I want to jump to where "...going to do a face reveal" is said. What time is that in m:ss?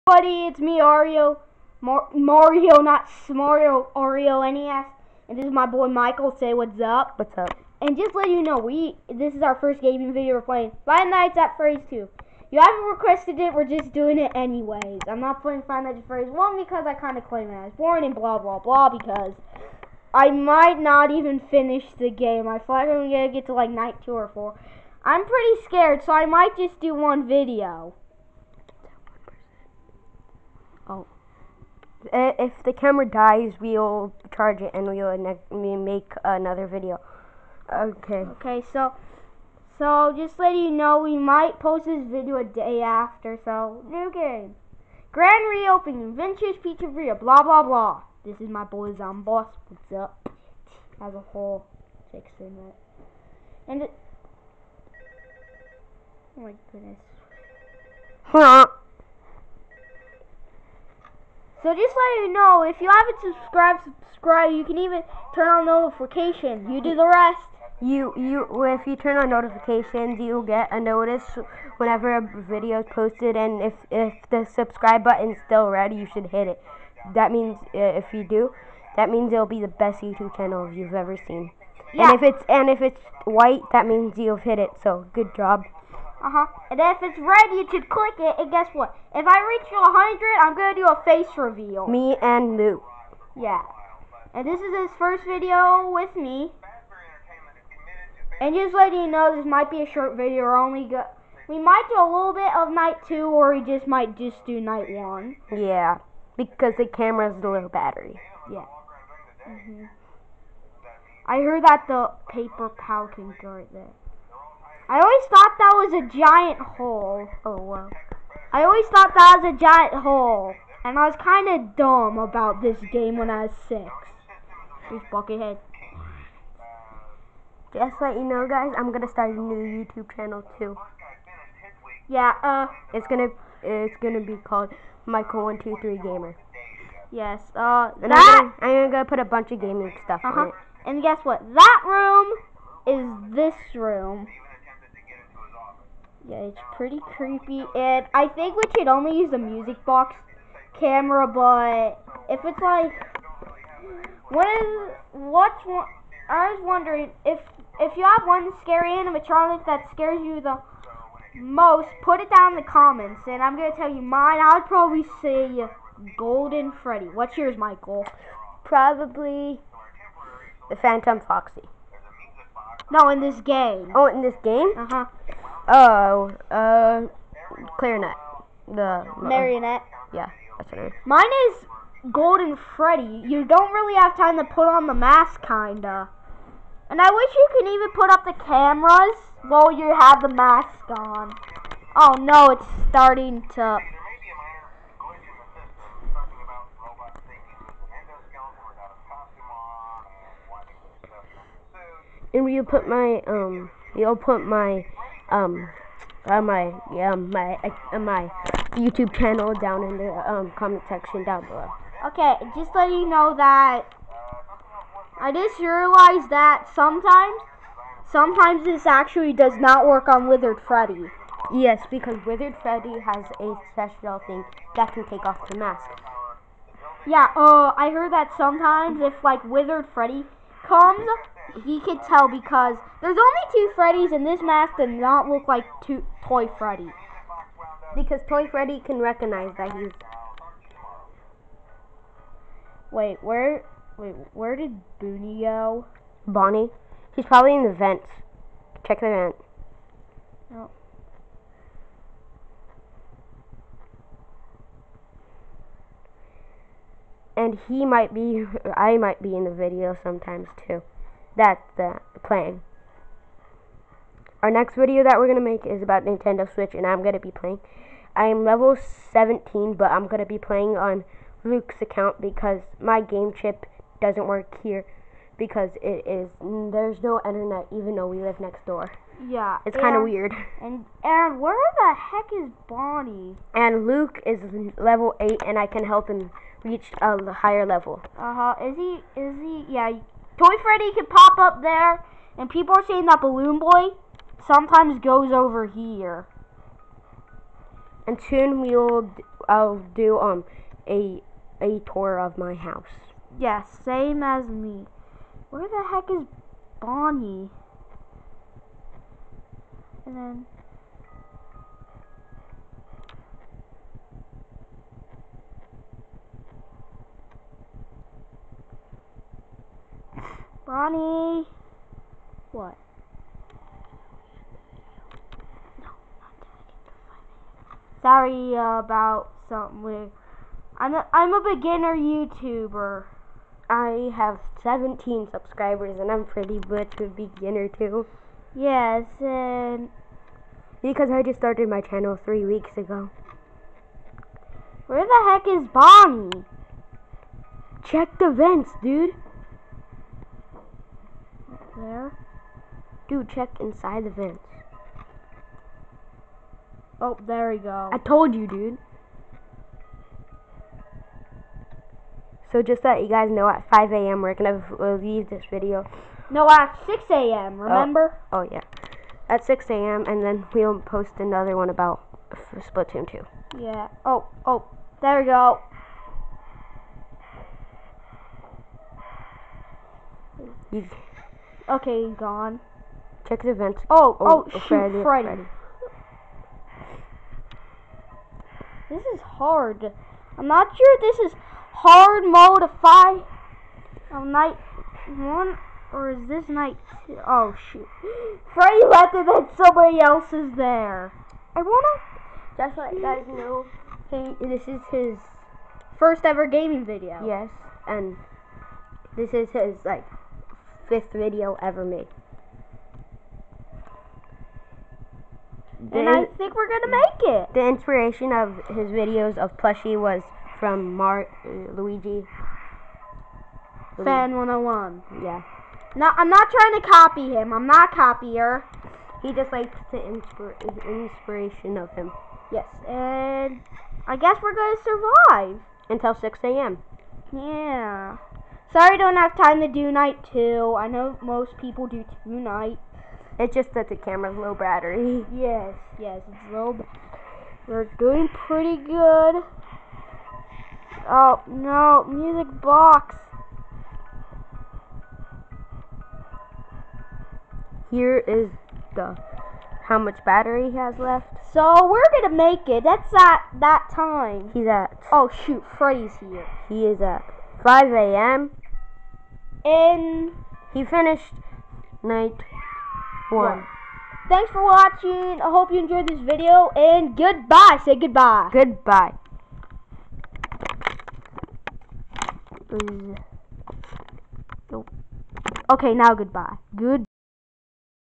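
1:30.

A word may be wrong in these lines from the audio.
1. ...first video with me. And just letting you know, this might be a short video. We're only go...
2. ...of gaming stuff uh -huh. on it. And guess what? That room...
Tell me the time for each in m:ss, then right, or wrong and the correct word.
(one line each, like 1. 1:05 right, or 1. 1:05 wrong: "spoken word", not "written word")
1. 1:34 right
2. 2:19 right.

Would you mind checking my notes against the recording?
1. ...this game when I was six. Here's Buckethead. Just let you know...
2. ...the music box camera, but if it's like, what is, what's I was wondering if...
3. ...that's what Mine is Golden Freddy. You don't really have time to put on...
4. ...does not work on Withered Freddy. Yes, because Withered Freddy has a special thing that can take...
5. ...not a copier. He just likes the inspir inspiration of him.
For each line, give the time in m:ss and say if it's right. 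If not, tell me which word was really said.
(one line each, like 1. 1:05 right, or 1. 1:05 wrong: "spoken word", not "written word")
1. 2:02 right
2. 2:29 right
3. 3:00 right
4. 3:39 right
5. 7:07 right.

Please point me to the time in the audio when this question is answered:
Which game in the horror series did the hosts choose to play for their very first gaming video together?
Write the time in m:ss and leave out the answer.
0:10.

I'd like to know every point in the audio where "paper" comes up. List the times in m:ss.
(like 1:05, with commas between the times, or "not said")
1:52.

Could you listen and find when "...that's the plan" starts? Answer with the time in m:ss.
4:21.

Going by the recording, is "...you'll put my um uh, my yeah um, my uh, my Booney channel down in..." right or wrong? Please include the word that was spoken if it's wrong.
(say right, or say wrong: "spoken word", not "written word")
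wrong: "YouTube", not "Booney".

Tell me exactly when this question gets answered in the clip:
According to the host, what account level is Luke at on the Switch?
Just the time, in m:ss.
4:45.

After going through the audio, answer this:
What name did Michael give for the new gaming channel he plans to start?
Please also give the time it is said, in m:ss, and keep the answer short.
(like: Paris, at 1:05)
Michael One Two Three Gamer, at 2:15.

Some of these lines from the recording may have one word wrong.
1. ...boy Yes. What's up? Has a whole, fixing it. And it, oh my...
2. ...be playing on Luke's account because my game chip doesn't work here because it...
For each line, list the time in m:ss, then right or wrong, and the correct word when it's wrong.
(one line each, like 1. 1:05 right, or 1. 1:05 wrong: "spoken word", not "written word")
1. 0:48 wrong: "Zomboss", not "Yes"
2. 4:30 right.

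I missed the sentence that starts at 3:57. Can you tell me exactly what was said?
Because Toy Freddy can recognize that he's.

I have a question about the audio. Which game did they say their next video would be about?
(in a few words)
Splatoon 2.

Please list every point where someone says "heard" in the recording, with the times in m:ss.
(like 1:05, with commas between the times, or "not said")
1:51, 3:47.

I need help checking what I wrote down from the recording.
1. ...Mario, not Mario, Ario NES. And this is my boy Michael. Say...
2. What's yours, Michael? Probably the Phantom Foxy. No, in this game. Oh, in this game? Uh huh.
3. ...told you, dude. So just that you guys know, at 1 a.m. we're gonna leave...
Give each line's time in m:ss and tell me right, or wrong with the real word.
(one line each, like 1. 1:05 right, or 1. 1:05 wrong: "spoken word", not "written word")
1. 0:02 right
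2. 2:47 right
3. 5:57 wrong: "5", not "1".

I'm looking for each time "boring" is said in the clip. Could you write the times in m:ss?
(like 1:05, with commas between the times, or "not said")
0:17.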